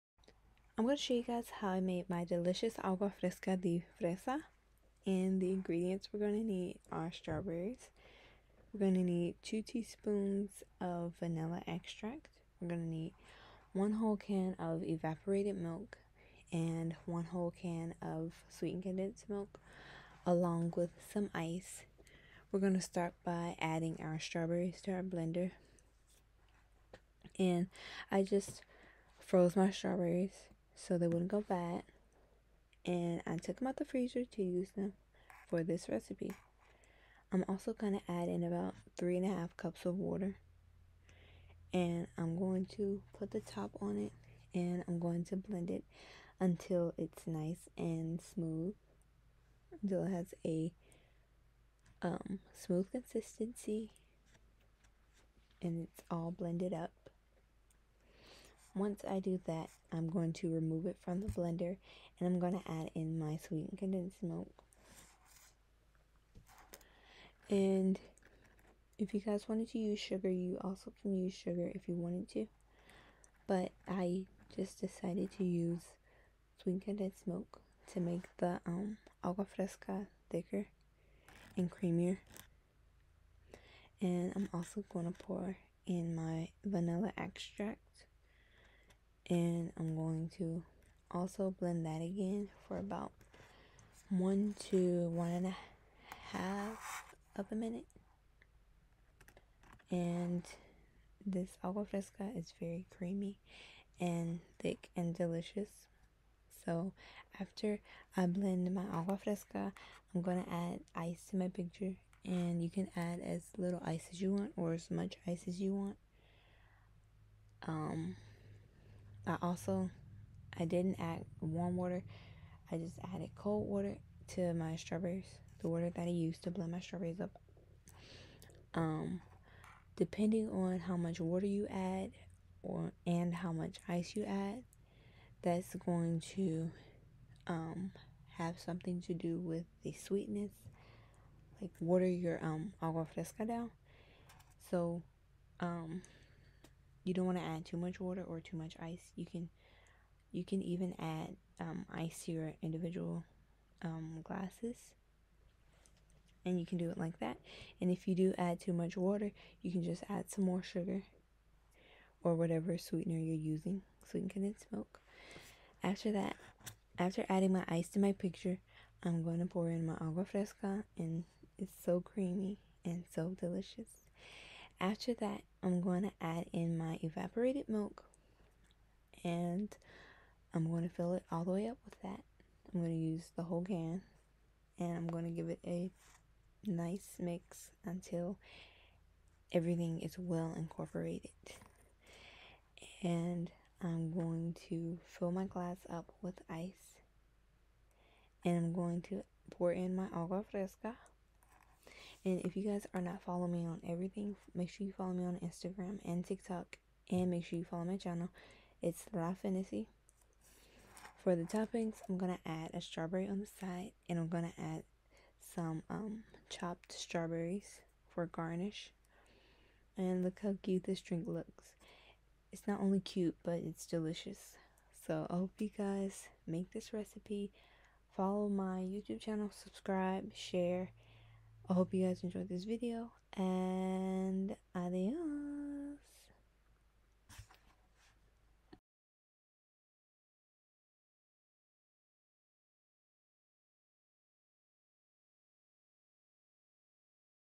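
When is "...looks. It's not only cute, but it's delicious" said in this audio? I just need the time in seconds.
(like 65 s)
221 s.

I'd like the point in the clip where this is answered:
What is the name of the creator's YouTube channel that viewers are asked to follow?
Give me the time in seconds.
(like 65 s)
209 s.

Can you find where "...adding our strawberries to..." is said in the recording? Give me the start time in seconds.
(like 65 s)
23 s.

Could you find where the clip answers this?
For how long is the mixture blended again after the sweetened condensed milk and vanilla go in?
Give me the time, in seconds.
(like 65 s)
94 s.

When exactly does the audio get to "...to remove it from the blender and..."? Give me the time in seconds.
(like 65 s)
60 s.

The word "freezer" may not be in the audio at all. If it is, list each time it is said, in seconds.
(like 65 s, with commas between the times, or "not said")
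33 s.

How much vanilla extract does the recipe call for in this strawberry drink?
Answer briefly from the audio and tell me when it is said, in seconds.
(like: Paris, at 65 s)
2 teaspoons, at 9 s.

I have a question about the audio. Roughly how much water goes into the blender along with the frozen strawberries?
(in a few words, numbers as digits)
3 and a half cups.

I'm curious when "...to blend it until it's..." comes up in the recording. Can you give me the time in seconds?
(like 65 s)
45 s.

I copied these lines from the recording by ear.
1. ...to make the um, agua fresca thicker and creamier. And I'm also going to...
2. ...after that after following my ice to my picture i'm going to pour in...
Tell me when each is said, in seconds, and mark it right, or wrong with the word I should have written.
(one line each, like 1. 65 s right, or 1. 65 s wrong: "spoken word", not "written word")
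1. 77 s right
2. 165 s wrong: "adding", not "following".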